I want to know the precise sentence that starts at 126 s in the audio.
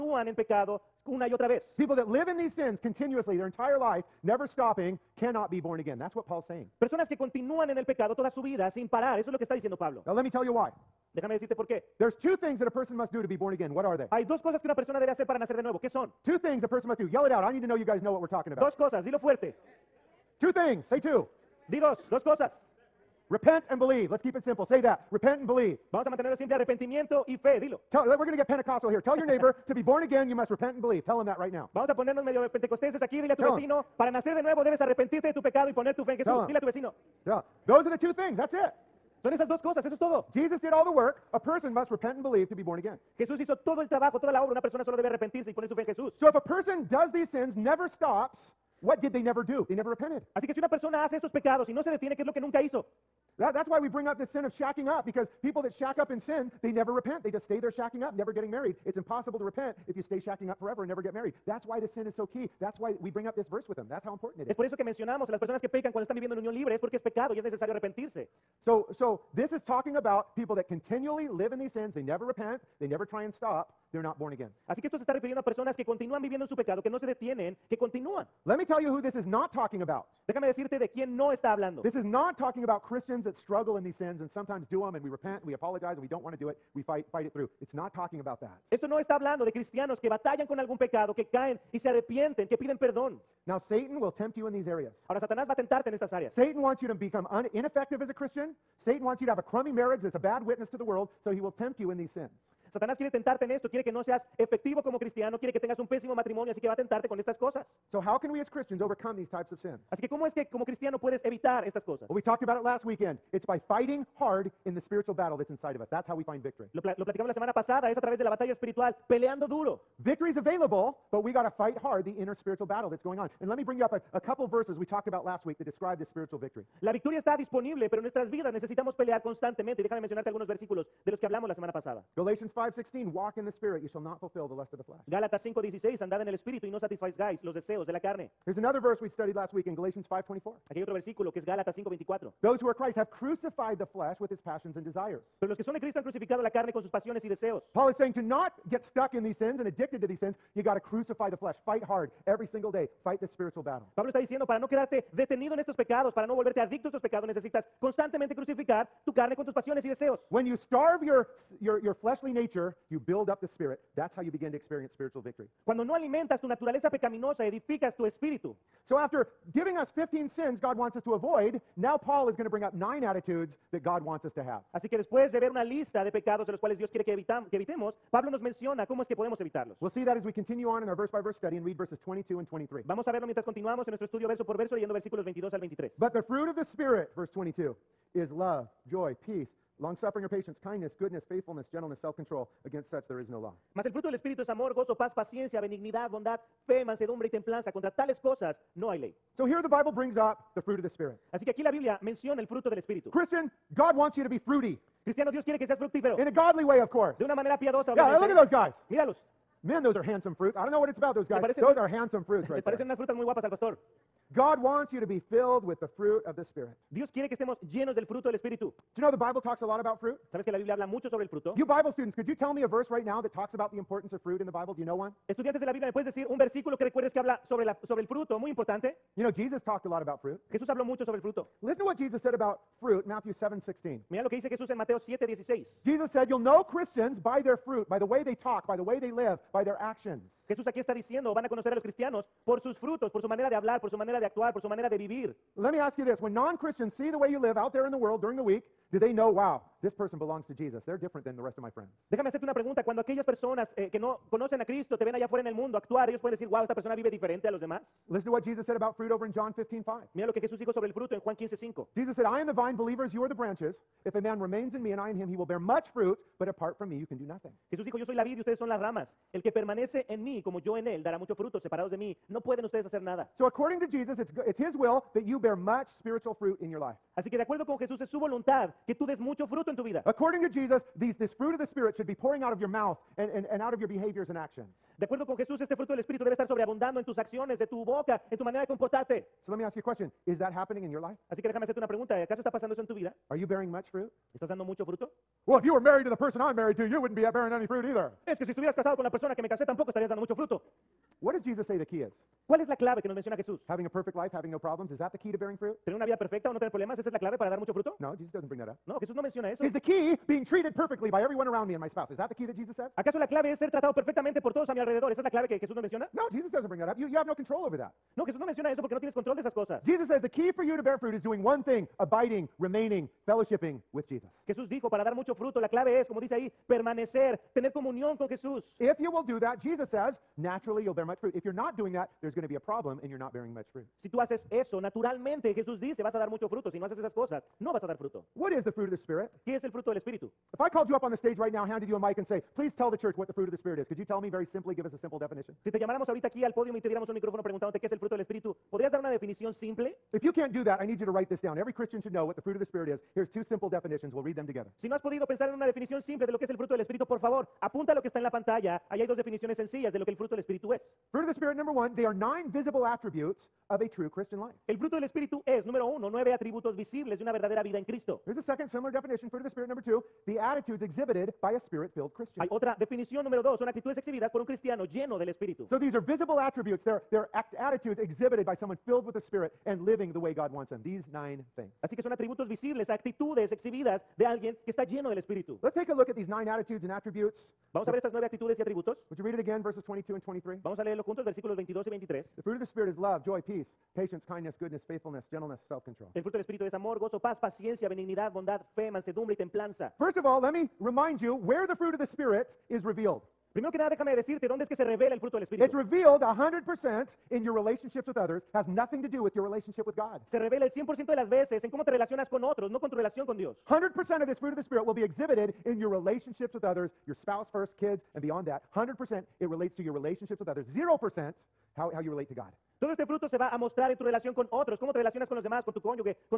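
La victoria está disponible, pero nuestras vidas necesitamos pelear constantemente.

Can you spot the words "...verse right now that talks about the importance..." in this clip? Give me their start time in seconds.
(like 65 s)
222 s.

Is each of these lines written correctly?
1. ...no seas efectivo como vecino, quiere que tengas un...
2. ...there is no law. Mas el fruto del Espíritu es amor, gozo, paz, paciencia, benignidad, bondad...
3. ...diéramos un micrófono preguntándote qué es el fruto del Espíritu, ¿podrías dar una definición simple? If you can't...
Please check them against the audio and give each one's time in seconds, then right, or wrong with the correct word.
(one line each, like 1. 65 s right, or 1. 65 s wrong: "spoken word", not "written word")
1. 103 s wrong: "cristiano", not "vecino"
2. 193 s right
3. 346 s right.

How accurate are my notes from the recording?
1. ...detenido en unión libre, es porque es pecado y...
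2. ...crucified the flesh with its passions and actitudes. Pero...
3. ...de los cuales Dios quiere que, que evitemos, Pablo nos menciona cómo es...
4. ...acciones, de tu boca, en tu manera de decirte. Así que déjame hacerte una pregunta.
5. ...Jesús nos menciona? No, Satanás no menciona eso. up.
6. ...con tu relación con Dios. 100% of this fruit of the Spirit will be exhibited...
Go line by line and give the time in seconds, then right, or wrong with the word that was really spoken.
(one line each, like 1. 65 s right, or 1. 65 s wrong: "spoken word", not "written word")
1. 66 s wrong: "viviendo", not "detenido"
2. 143 s wrong: "desires", not "actitudes"
3. 176 s right
4. 287 s wrong: "comportarte", not "decirte"
5. 315 s wrong: "Jesús", not "Satanás"
6. 412 s right.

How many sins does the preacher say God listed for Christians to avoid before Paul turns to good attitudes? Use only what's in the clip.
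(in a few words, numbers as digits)
15.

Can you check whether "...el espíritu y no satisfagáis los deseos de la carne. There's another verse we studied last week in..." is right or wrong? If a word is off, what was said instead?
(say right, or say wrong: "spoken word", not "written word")
right.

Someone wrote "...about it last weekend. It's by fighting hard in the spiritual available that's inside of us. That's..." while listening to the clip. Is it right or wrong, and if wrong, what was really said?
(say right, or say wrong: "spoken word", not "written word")
wrong: "battle", not "available".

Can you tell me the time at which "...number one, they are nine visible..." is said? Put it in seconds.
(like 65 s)
361 s.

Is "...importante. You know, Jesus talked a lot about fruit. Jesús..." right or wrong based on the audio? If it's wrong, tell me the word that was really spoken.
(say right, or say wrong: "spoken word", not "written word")
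right.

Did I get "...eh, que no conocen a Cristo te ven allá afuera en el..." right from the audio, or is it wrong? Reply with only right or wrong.
right.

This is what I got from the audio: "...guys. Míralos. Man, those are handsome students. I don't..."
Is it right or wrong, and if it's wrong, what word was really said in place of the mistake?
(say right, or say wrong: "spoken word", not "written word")
wrong: "fruits", not "students".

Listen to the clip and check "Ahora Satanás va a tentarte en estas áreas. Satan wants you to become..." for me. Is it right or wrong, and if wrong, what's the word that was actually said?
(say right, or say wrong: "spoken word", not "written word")
right.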